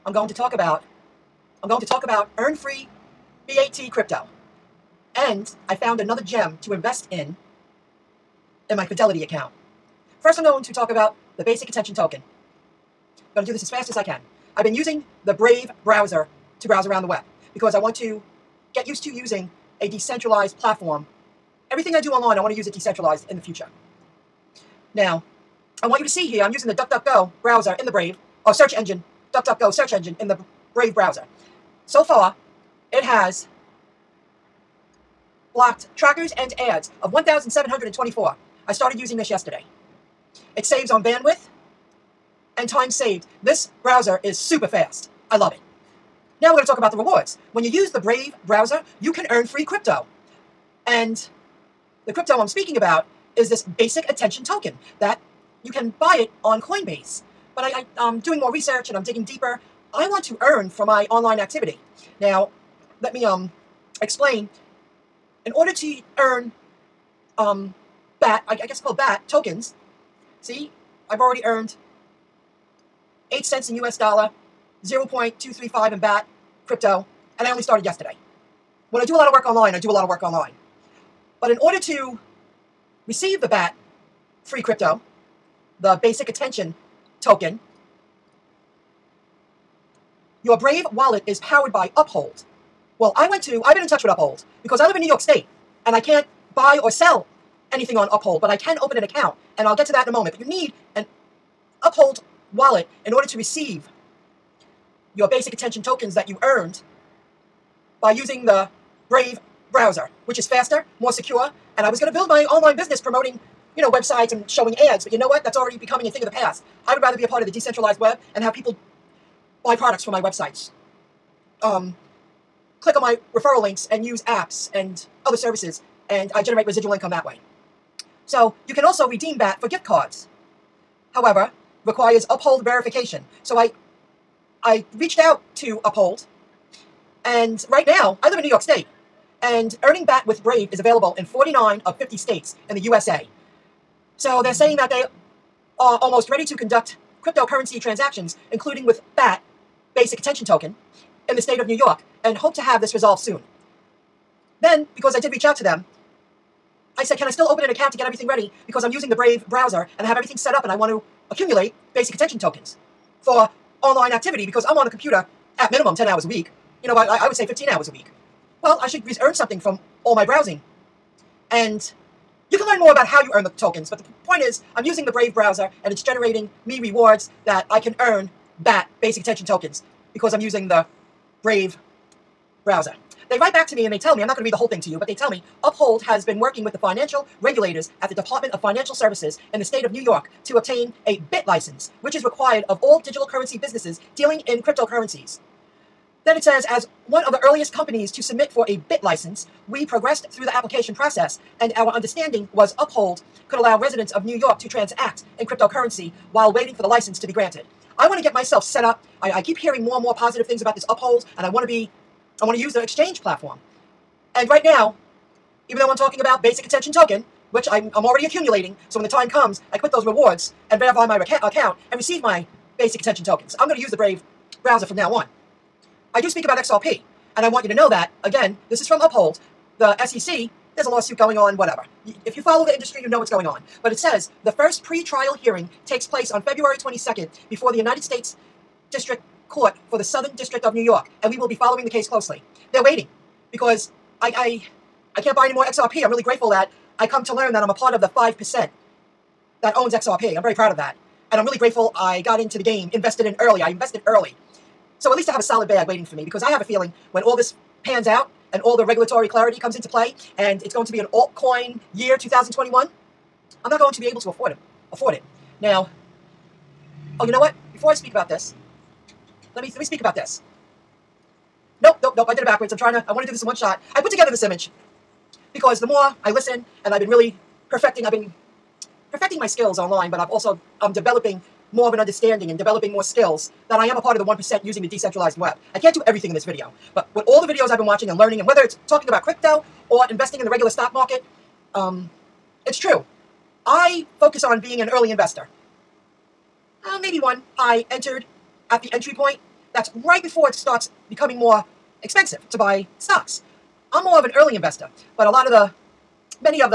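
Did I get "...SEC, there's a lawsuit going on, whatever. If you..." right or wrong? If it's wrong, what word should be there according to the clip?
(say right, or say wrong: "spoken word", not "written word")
right.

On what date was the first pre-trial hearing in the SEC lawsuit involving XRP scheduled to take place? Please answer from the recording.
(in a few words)
February 22nd.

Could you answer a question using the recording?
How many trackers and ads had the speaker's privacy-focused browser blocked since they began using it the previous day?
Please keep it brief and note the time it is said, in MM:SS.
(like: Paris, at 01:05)
1,724, at 00:37.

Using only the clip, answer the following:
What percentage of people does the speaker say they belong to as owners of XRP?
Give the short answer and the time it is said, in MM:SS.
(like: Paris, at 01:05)
5%, at 04:08.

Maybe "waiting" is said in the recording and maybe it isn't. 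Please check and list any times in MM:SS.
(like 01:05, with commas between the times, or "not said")
03:26, 04:02, 04:15.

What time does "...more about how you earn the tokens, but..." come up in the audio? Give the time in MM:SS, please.
02:52.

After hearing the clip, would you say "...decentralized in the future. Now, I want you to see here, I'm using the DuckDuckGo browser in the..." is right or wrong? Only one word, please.
right.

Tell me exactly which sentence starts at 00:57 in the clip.
But I, I, am um, doing more research and I'm digging deeper.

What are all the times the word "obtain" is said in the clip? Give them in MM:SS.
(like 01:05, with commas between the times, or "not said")
03:10.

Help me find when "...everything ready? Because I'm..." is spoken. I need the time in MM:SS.
02:38.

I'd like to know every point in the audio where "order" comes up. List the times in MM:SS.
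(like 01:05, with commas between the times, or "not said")
01:05, 01:21, 01:43.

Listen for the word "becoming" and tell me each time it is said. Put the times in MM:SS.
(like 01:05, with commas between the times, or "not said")
01:55, 05:01.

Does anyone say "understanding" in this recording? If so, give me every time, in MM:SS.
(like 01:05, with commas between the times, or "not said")
03:21, 04:41.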